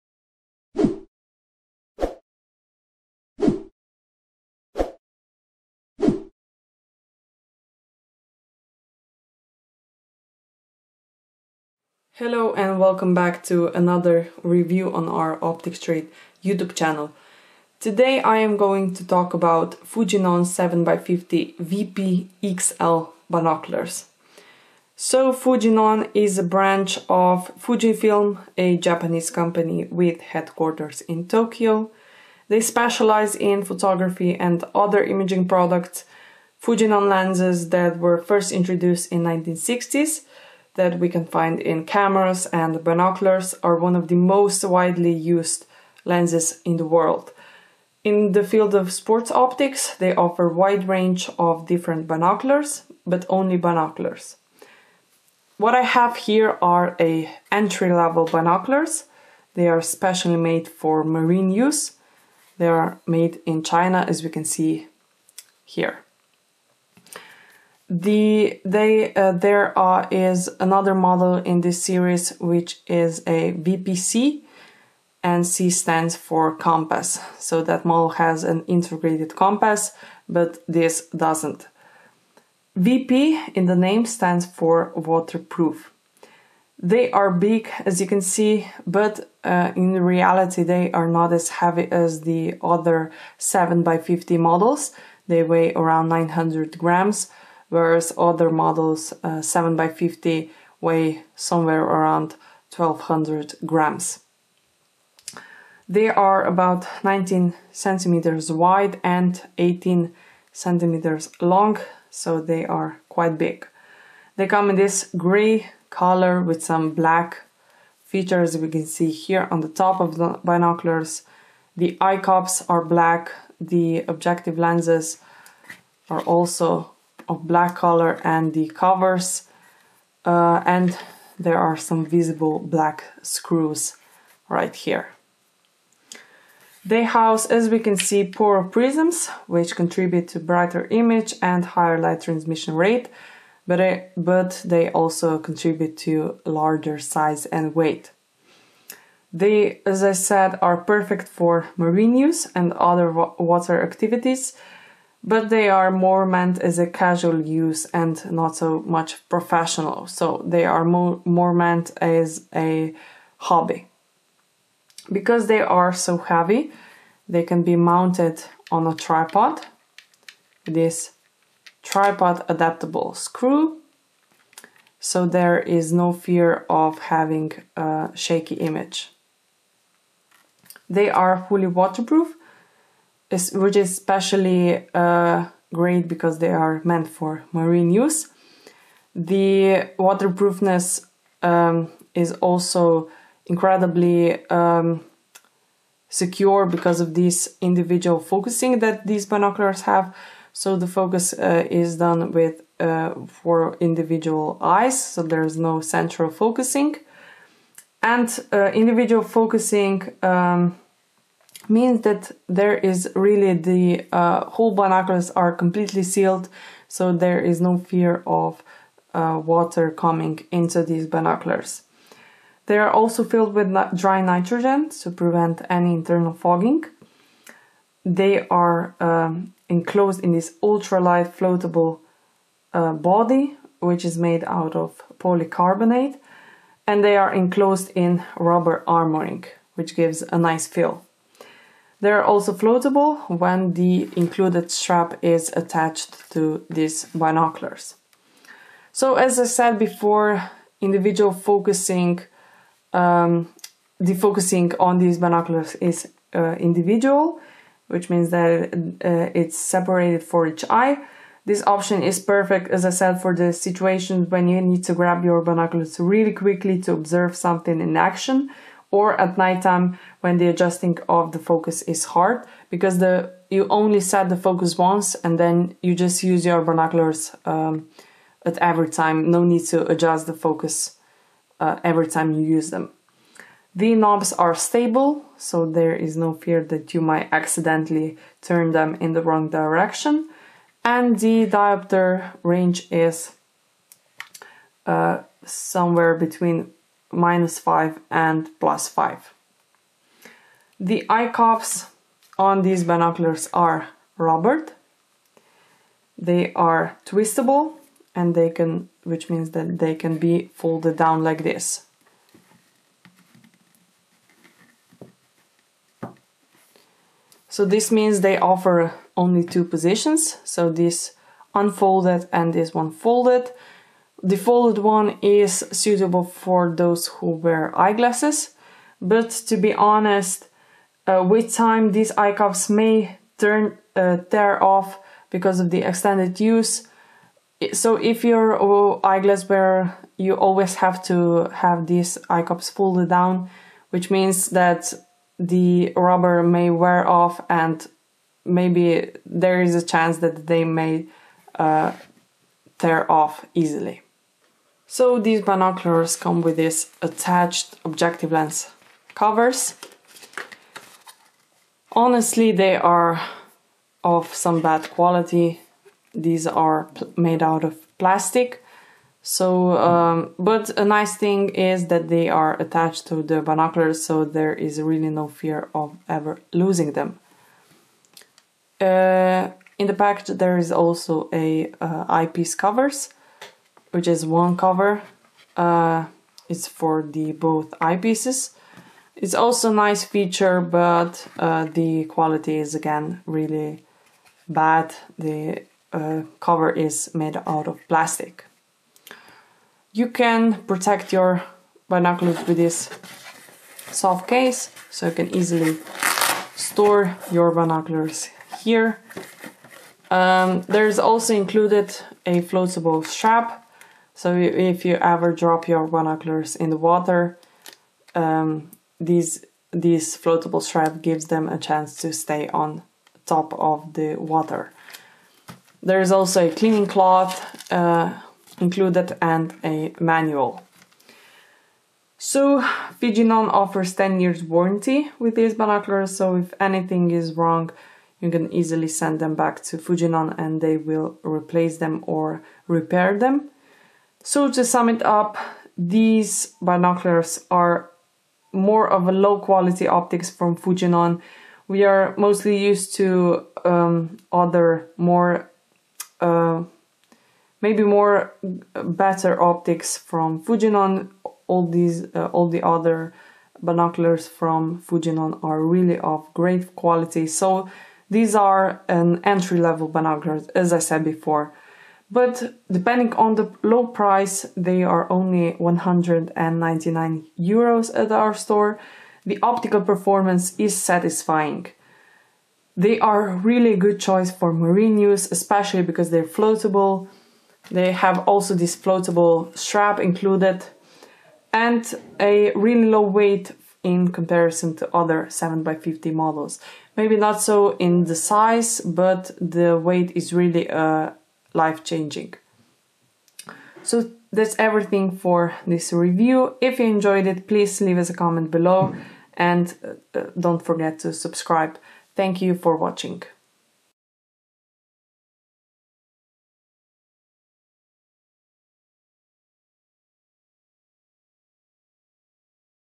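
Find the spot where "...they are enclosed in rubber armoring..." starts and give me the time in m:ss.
3:57.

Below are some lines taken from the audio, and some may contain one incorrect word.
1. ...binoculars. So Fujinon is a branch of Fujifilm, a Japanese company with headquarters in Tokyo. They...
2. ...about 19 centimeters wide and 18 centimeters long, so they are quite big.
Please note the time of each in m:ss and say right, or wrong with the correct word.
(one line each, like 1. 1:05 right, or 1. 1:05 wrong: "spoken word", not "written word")
1. 0:23 right
2. 1:46 right.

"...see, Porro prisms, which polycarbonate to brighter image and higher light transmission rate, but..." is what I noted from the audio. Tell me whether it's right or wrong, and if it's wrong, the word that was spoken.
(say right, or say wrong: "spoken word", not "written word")
wrong: "contribute", not "polycarbonate".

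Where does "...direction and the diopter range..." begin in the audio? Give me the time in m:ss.
4:49.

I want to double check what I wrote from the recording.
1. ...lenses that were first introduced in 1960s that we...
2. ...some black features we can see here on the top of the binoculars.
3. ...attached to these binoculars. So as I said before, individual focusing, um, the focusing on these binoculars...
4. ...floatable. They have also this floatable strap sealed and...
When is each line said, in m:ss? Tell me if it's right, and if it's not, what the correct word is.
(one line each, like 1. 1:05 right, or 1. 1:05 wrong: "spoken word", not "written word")
1. 0:37 right
2. 1:56 right
3. 4:05 right
4. 8:06 wrong: "included", not "sealed".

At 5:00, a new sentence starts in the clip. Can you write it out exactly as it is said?
The eye cuffs on these binoculars are rubbered.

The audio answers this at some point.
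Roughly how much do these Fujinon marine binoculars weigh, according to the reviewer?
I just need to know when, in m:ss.
1:36.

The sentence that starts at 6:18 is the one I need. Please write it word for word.
Uh, in the package, there is also a uh, eyepiece covers which is one cover.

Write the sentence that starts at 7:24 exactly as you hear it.
So to sum it up, these binoculars are more of a low quality optics from Fujinon.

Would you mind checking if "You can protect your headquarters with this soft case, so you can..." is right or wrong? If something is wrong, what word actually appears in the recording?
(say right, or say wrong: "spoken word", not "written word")
wrong: "binoculars", not "headquarters".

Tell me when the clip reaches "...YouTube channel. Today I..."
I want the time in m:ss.
0:16.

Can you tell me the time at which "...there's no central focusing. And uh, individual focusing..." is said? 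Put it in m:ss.
3:25.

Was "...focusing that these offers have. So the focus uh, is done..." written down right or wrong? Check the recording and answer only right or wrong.
wrong.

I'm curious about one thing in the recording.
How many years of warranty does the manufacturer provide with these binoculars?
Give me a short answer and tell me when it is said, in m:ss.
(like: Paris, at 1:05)
10 years, at 7:13.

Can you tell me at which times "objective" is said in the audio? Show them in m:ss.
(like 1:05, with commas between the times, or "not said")
2:04, 5:57.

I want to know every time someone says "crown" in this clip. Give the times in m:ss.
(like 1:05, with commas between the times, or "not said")
not said.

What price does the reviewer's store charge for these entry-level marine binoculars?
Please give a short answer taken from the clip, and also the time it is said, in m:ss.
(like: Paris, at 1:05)
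199 euros, at 7:55.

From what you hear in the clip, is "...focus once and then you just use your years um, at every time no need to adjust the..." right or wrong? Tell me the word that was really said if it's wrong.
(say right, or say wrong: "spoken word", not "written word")
wrong: "binoculars", not "years".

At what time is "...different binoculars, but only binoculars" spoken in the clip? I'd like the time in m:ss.
0:51.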